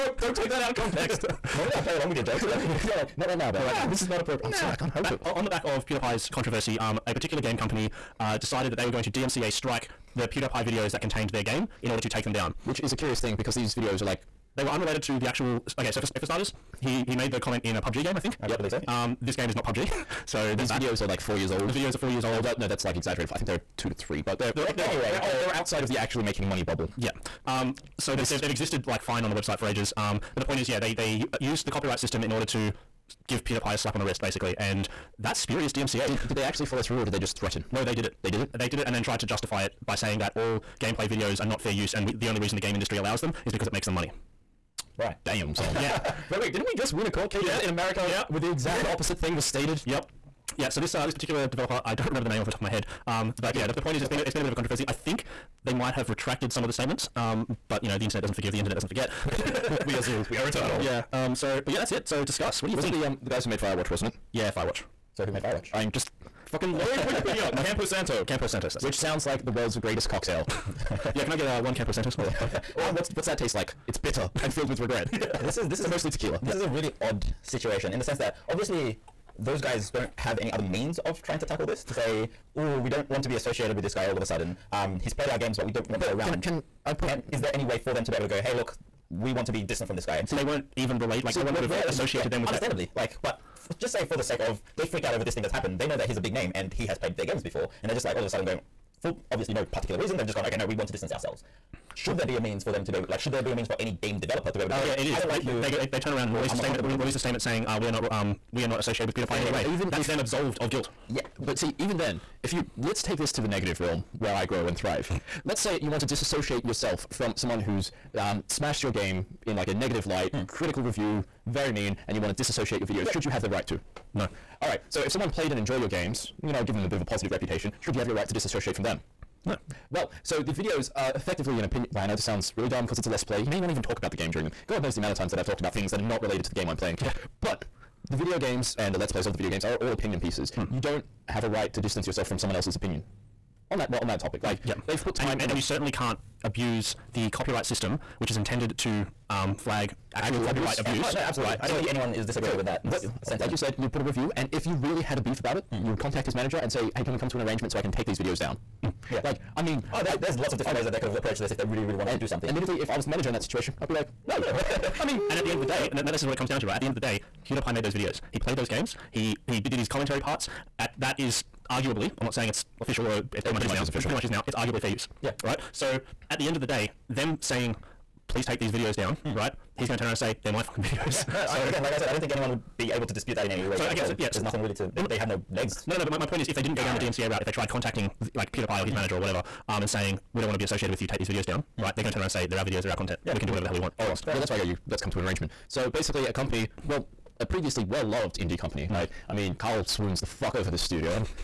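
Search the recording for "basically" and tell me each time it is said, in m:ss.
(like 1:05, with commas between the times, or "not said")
0:34, 3:15.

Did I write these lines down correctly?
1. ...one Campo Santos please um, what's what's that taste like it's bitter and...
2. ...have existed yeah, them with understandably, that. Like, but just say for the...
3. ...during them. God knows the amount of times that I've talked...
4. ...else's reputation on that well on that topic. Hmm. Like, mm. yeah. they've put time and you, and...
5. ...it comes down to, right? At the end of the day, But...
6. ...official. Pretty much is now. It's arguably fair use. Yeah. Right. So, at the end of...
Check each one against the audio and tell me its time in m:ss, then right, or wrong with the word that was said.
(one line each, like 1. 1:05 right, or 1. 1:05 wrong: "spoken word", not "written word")
1. 1:11 right
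2. 1:31 wrong: "associated", not "existed"
3. 2:14 right
4. 2:22 wrong: "opinion", not "reputation"
5. 2:46 wrong: "PewDiePie", not "But"
6. 2:53 right.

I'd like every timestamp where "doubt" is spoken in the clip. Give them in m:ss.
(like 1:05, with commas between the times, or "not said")
not said.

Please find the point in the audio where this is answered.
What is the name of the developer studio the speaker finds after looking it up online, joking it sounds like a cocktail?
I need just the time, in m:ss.
1:07.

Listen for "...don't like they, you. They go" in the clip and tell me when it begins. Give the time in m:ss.
1:45.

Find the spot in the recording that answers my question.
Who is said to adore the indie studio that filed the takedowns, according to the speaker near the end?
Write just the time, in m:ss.
3:19.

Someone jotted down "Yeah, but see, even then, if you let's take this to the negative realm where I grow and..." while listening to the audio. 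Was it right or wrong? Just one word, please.
right.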